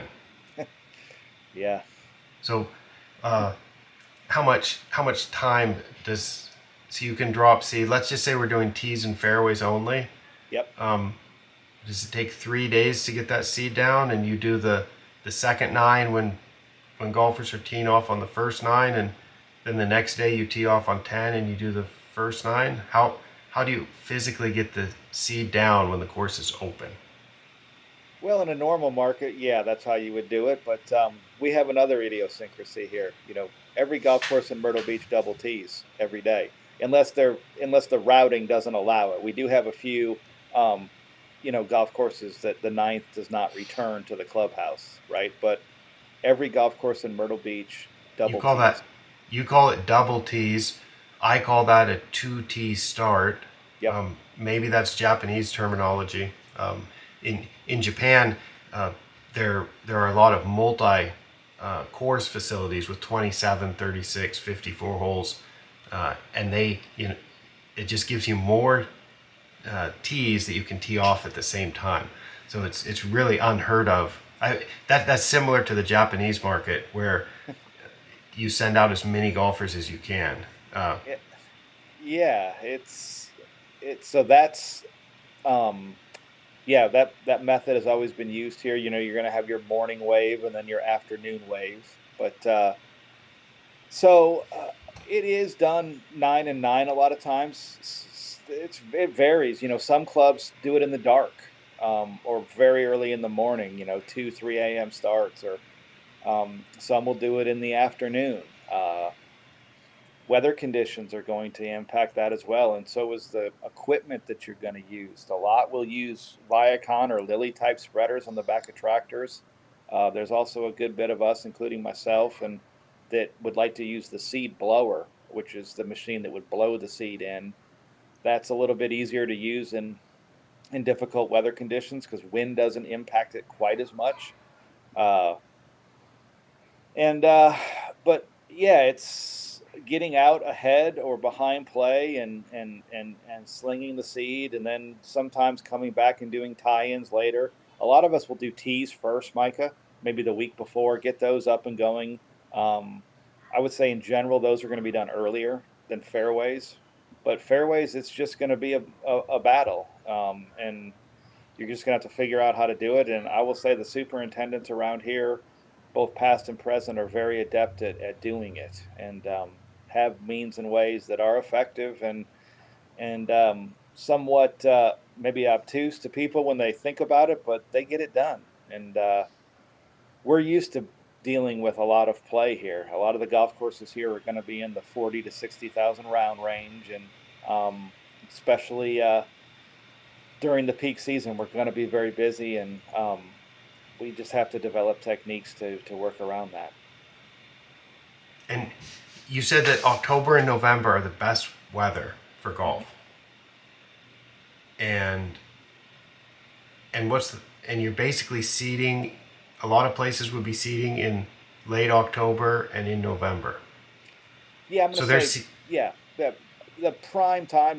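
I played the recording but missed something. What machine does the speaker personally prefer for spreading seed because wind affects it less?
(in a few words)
seed blower.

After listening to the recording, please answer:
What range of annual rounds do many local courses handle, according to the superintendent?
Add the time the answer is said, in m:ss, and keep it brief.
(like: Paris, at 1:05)
40,000 to 60,000, at 3:04.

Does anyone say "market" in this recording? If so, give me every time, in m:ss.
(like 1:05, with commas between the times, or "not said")
0:28, 1:16.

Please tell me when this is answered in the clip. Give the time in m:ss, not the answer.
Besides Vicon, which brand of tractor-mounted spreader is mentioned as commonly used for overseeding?
1:57.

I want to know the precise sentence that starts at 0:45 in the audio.
But every golf course in Myrtle Beach double.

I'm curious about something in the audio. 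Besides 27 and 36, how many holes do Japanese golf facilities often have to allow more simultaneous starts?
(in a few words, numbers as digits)
54.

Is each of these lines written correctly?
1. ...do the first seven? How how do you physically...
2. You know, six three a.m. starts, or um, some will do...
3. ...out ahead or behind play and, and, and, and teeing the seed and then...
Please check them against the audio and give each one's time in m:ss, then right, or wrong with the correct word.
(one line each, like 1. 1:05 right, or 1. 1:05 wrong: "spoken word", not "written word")
1. 0:21 wrong: "nine", not "seven"
2. 1:43 wrong: "two", not "six"
3. 2:20 wrong: "slinging", not "teeing".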